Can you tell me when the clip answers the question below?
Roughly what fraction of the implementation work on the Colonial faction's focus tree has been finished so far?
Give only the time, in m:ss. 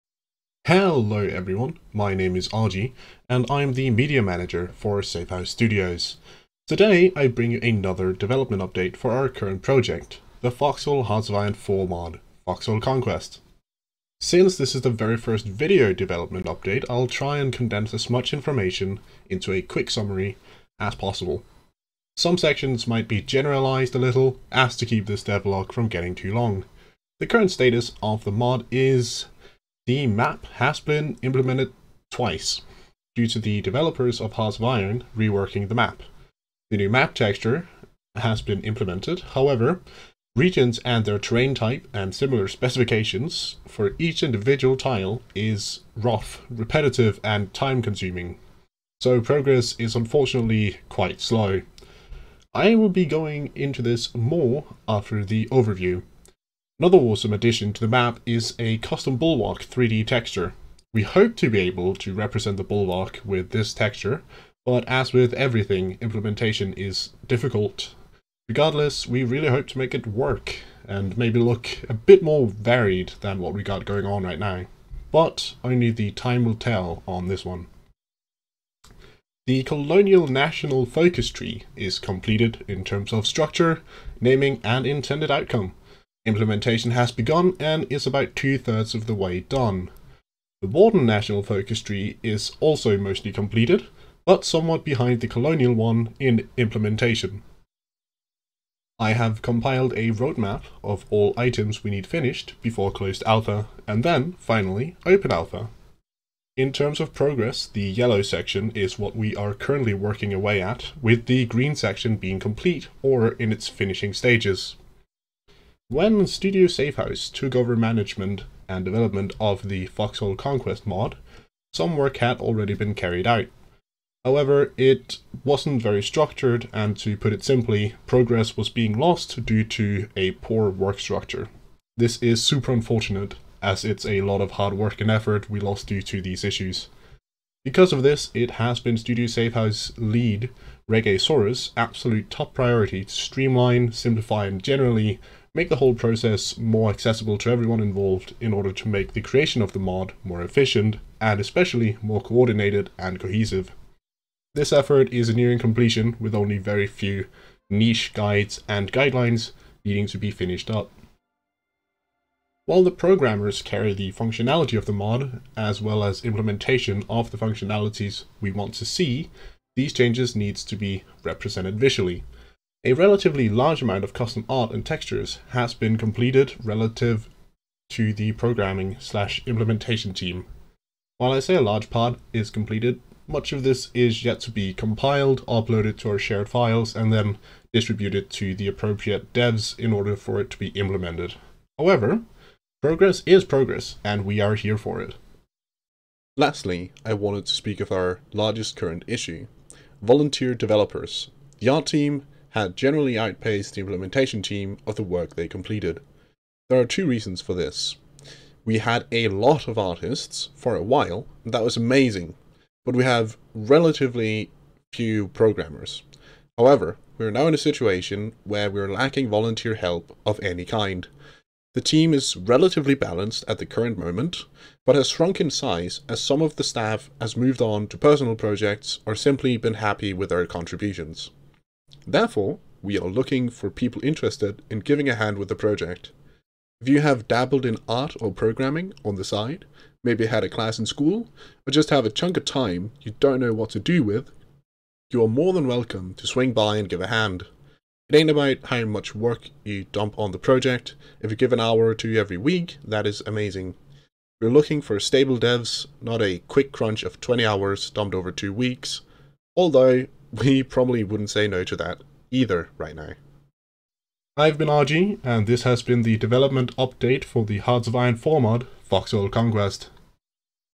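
1:28.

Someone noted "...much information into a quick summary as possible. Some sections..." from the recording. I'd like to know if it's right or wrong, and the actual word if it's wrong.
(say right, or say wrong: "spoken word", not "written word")
right.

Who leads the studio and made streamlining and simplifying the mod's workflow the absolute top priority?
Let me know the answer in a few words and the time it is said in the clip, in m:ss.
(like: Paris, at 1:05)
RegaSaurus, at 2:20.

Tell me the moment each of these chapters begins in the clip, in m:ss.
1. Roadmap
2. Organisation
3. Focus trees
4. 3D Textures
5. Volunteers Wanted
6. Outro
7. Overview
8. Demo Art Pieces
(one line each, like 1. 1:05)
1. 1:40
2. 1:57
3. 1:19
4. 0:56
5. 3:16
6. 4:24
7. 0:27
8. 2:42.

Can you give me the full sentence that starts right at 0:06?
Today I bring you another development update for our current project, the Foxhole Hearts of Iron 4 mod, Foxhole Conquest.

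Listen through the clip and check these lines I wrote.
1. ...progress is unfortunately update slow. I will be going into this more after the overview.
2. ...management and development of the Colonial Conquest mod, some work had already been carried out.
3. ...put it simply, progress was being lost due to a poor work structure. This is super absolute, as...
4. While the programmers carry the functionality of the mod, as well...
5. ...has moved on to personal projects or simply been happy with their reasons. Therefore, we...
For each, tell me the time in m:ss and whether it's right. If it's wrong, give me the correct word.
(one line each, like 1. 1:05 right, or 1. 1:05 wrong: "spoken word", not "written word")
1. 0:49 wrong: "quite", not "update"
2. 1:57 wrong: "Foxhole", not "Colonial"
3. 2:07 wrong: "unfortunate", not "absolute"
4. 2:42 right
5. 3:47 wrong: "contributions", not "reasons".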